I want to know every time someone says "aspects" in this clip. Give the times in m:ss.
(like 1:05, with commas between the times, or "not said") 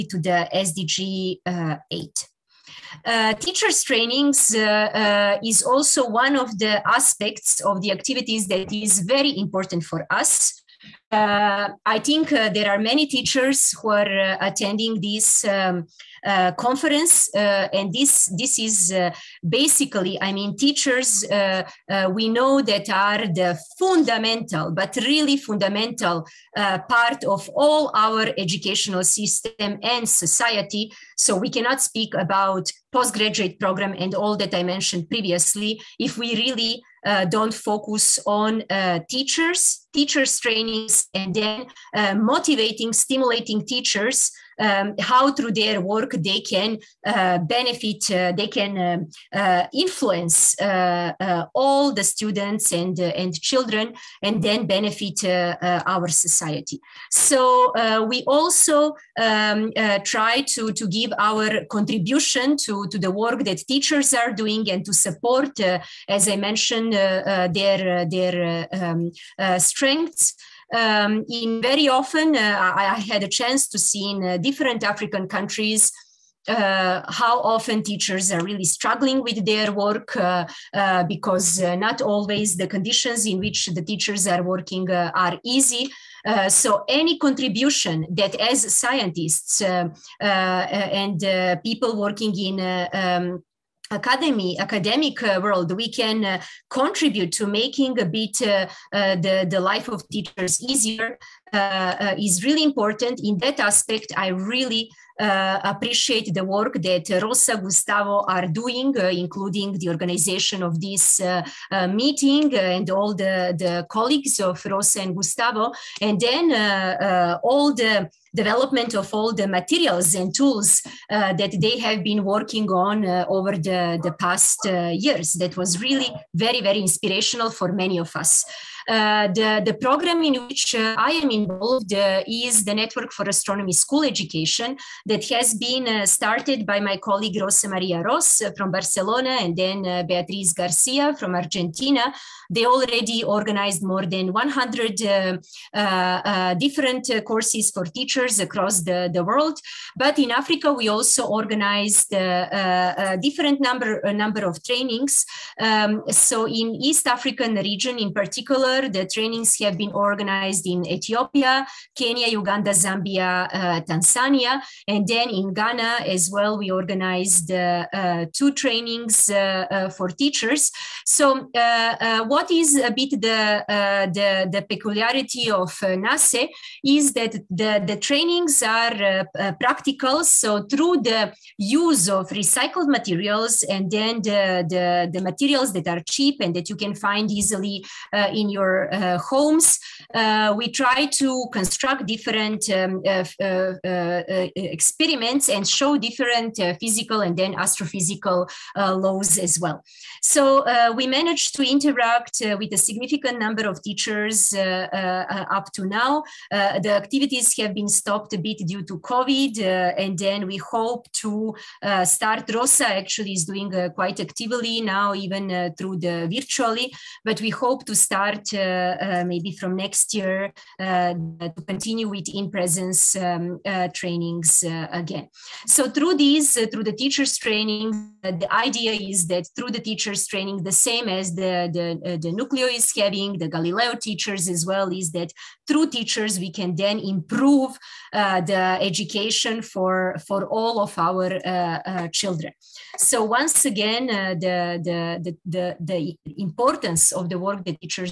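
0:06, 1:43.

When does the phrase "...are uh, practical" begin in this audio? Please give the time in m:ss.
2:58.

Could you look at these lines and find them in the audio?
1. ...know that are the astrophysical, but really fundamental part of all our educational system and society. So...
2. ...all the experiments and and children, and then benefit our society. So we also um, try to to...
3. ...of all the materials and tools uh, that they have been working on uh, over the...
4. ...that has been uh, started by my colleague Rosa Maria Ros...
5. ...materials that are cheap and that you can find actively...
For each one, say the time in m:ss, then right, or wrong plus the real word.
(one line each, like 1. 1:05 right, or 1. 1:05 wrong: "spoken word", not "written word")
1. 0:22 wrong: "fundamental", not "astrophysical"
2. 0:51 wrong: "students", not "experiments"
3. 1:58 right
4. 2:15 right
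5. 3:05 wrong: "easily", not "actively".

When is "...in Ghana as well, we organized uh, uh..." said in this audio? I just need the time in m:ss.
2:45.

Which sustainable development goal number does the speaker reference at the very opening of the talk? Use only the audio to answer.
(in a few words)
SDG 8.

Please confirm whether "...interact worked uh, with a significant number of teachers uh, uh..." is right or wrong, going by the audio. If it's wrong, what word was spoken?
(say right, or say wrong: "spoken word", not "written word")
right.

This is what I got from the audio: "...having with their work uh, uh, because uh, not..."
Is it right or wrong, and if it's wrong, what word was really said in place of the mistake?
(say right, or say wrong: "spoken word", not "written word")
wrong: "struggling", not "having".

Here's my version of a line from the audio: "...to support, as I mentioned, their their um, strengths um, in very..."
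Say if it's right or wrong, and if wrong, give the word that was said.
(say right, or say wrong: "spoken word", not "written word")
right.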